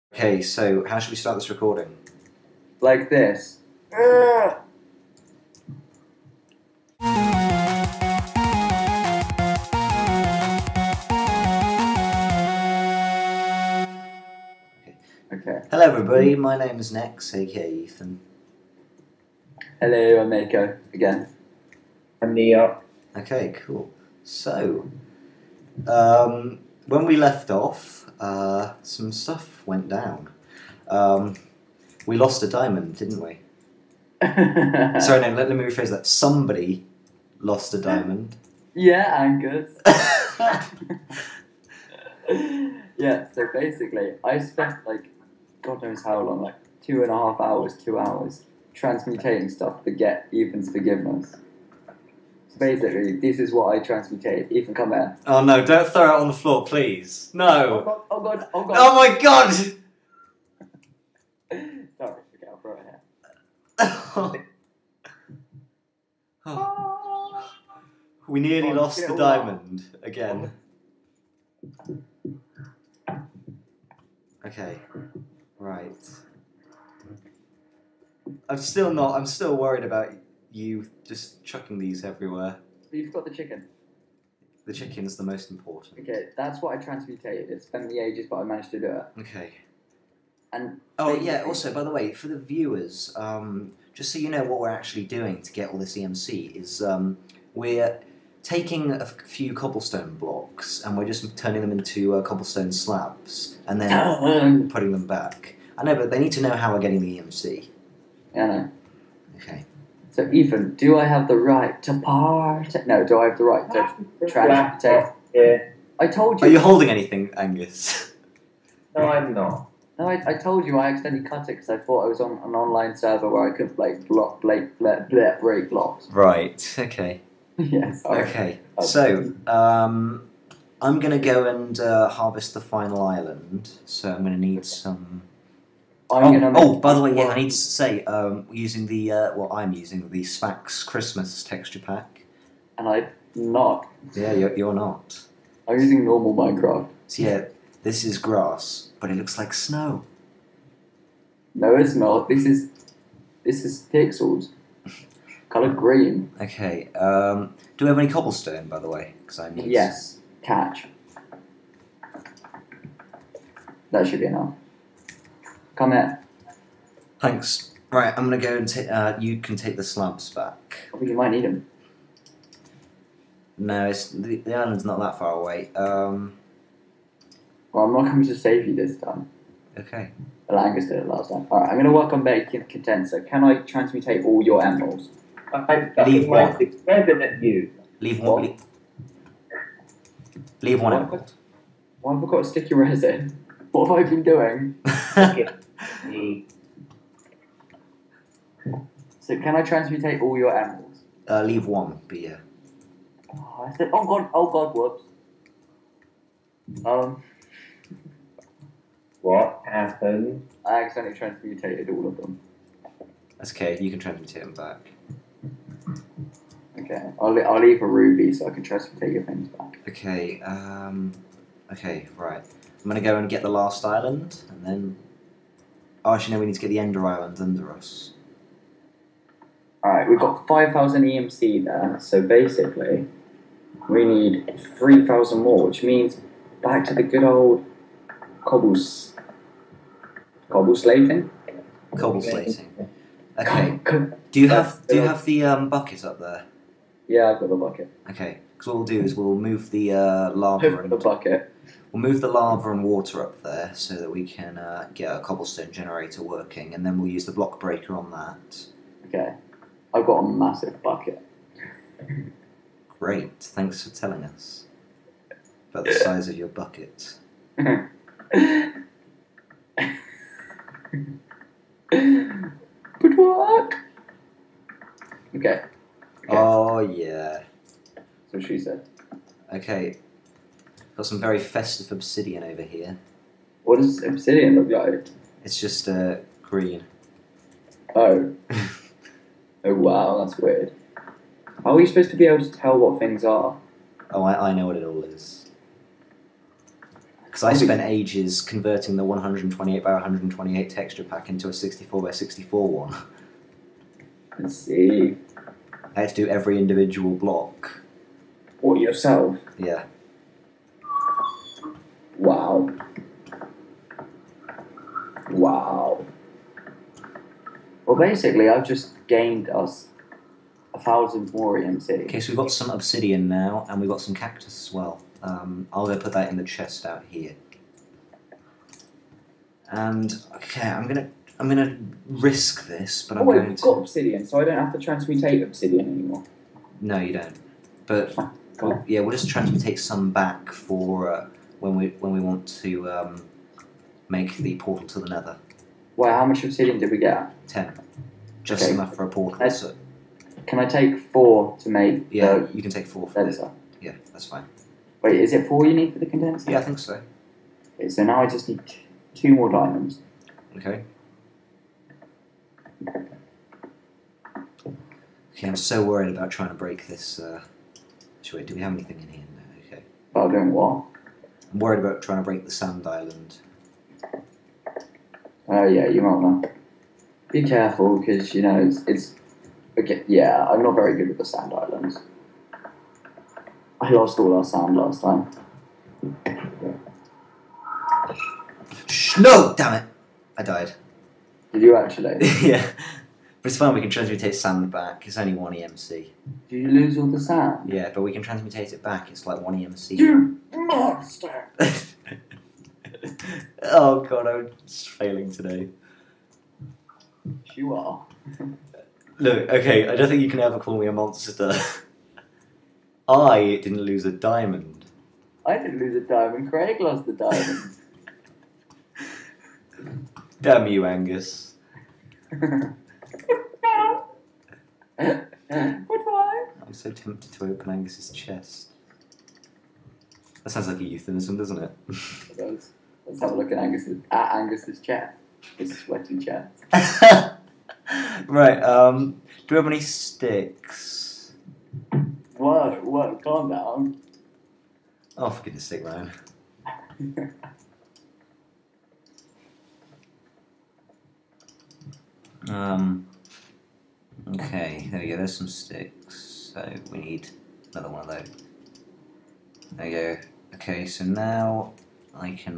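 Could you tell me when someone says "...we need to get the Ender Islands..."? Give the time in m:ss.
3:46.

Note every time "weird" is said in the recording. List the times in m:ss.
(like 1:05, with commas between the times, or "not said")
4:50.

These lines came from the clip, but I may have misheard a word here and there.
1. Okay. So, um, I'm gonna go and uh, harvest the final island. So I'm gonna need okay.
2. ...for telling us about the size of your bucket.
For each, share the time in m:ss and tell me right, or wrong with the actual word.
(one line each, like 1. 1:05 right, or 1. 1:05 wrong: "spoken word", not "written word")
1. 2:08 right
2. 4:23 right.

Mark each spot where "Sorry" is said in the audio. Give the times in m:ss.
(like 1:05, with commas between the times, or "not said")
0:35, 1:01.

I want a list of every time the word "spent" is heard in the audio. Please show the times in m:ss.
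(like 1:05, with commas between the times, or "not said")
0:44, 4:57.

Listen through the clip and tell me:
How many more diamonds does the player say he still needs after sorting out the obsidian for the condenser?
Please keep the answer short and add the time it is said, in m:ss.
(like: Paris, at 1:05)
2, at 5:59.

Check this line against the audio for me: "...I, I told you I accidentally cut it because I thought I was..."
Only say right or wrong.
right.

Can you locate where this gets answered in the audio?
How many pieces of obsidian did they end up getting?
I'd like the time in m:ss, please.
5:47.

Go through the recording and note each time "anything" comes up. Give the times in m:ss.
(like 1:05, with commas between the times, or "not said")
1:56, 6:08.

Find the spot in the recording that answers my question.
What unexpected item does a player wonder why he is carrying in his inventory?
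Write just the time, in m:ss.
3:12.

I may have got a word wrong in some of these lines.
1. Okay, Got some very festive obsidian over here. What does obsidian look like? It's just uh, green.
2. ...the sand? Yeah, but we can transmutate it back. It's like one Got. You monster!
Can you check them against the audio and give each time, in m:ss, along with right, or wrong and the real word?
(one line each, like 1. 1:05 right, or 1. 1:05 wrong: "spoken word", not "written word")
1. 4:39 right
2. 6:37 wrong: "EMC", not "Got".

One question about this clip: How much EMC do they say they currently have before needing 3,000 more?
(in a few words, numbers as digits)
5,000.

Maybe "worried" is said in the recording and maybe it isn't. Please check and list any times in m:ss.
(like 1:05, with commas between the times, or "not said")
1:19, 6:05, 6:11.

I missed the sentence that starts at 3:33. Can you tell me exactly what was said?
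That's okay, you can transmute him back.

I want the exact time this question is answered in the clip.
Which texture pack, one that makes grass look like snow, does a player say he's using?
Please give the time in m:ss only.
2:20.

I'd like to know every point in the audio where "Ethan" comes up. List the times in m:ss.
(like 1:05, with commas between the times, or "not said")
0:17, 0:50, 0:54.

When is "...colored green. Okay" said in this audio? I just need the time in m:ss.
2:35.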